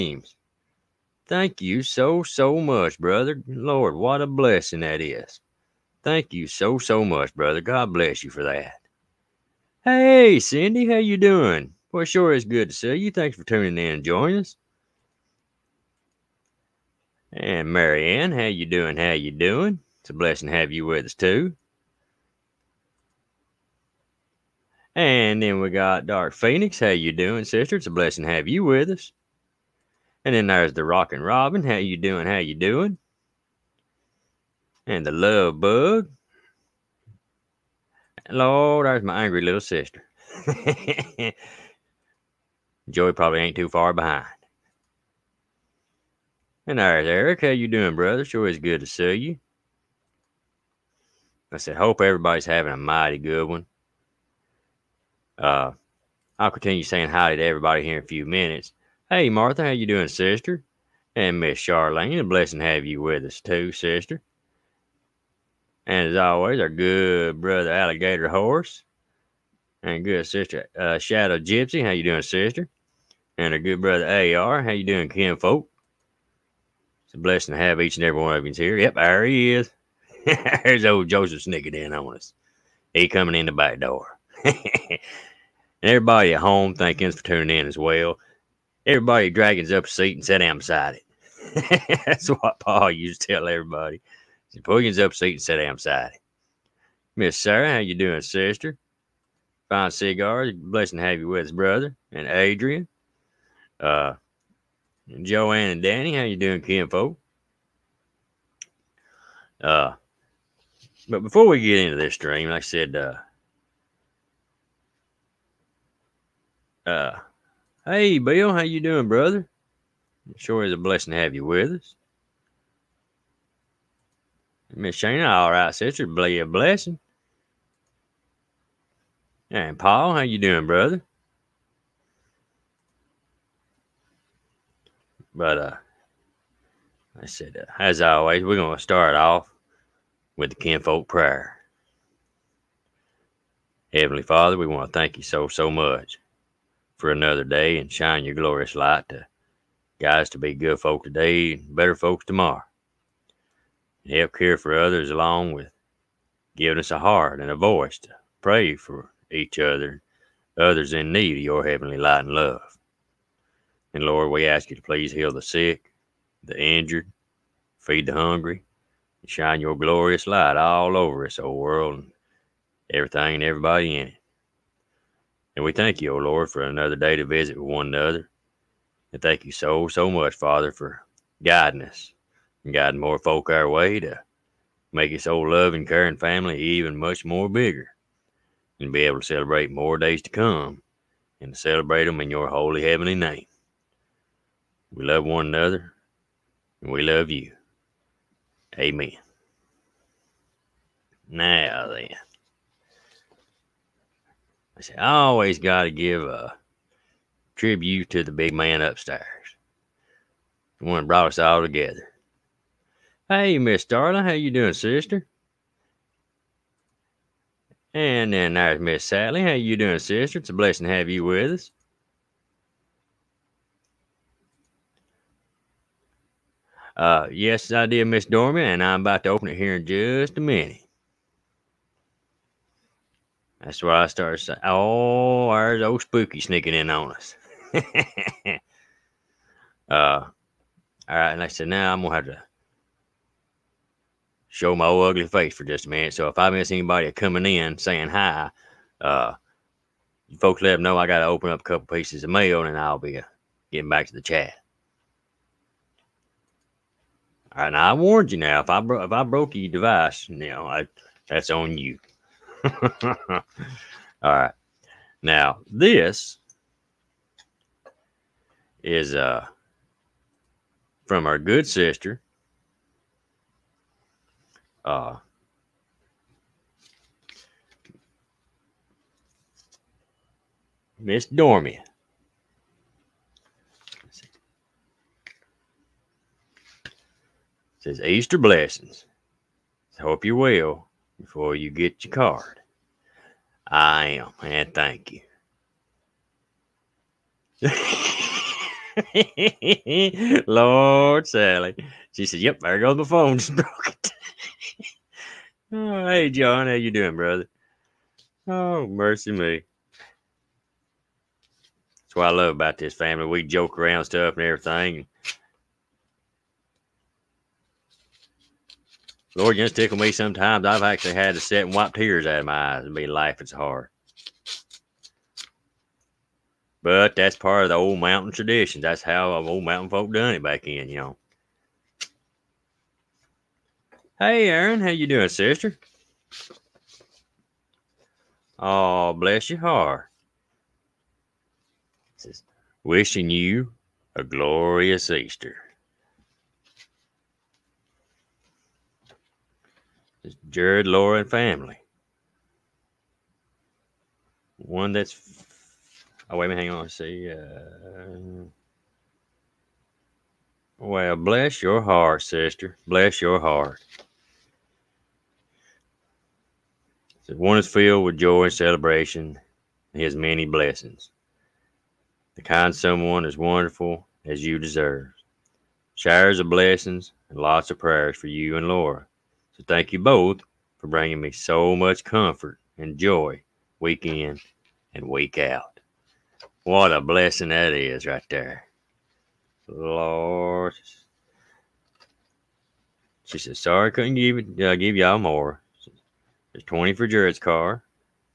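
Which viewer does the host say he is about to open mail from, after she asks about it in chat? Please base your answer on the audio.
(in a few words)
Miss Dorman.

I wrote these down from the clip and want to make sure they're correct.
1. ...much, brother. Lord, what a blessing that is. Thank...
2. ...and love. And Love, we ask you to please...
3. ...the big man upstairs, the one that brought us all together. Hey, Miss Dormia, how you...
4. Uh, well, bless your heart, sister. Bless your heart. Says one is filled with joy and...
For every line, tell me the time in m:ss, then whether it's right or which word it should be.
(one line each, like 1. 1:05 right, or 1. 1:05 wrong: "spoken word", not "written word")
1. 0:02 right
2. 2:42 wrong: "Lord", not "Love"
3. 3:28 wrong: "Darling", not "Dormia"
4. 5:57 right.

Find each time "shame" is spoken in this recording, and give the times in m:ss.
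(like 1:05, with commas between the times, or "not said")
not said.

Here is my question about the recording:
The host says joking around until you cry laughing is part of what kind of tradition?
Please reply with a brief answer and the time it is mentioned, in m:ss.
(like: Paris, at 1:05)
Old mountain tradition, at 5:27.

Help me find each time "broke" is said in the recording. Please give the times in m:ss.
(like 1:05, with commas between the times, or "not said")
4:19, 5:03.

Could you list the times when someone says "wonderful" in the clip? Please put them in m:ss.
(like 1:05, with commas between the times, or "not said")
6:13.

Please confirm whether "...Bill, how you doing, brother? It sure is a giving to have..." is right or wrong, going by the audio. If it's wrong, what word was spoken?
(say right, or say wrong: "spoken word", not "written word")
wrong: "blessing", not "giving".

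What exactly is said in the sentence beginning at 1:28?
Everybody dragons up a seat and sit down beside it.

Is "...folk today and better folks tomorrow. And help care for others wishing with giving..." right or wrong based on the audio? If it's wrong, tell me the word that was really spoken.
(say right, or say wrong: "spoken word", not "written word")
wrong: "along", not "wishing".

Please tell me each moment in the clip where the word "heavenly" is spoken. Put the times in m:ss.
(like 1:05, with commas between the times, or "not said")
2:23, 2:41, 3:12.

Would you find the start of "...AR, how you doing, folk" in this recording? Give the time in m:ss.
1:14.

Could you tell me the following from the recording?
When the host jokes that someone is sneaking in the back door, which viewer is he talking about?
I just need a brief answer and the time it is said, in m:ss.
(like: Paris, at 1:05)
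Joseph, at 1:21.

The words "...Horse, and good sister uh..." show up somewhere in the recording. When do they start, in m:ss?
1:08.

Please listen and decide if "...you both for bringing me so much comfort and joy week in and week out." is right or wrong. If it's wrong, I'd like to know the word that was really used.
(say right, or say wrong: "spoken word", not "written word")
right.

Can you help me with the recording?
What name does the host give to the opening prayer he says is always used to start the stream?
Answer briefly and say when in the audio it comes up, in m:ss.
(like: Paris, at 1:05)
Kinfolk prayer, at 2:20.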